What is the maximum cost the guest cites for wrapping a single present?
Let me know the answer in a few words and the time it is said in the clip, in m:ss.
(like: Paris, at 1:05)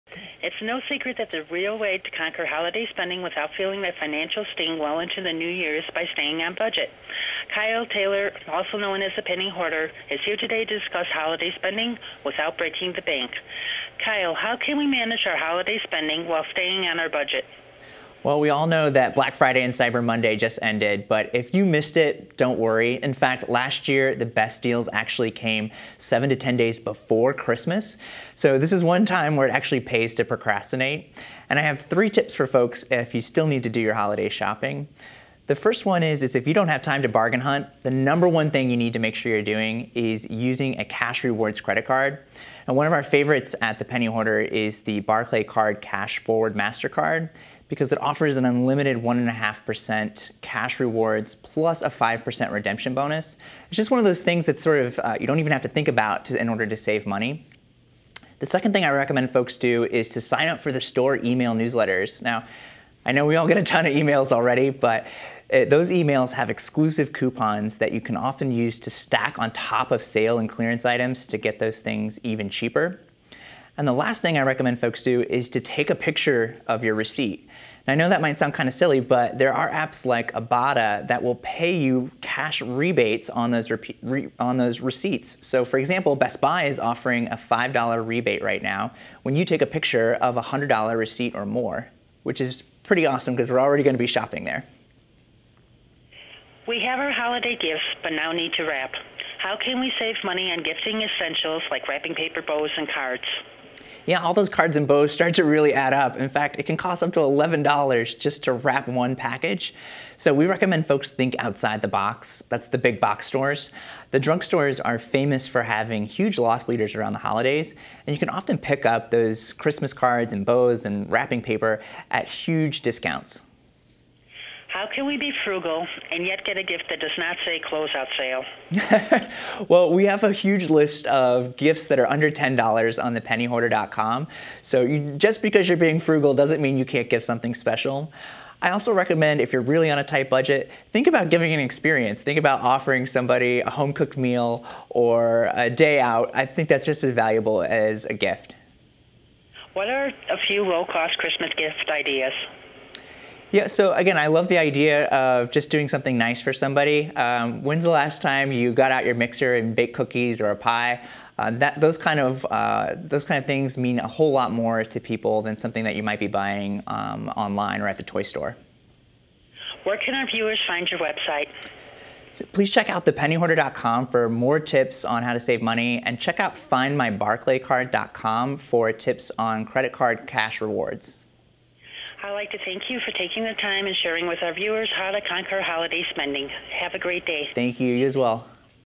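$11, at 1:47.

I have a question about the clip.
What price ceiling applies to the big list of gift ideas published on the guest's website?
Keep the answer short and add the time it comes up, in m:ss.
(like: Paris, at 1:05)
Under $10, at 2:12.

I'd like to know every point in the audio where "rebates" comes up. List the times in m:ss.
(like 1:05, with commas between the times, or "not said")
1:22, 1:28.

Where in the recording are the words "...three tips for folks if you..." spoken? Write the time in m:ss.
0:31.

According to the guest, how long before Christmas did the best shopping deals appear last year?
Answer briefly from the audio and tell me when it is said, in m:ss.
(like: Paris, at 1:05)
7 to 10 days, at 0:25.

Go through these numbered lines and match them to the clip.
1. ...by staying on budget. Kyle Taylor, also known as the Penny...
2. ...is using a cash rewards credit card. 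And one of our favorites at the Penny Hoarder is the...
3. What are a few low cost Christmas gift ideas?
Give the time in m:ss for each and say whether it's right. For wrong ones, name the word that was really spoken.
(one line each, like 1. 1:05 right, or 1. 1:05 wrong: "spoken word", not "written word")
1. 0:05 right
2. 0:39 right
3. 2:29 right.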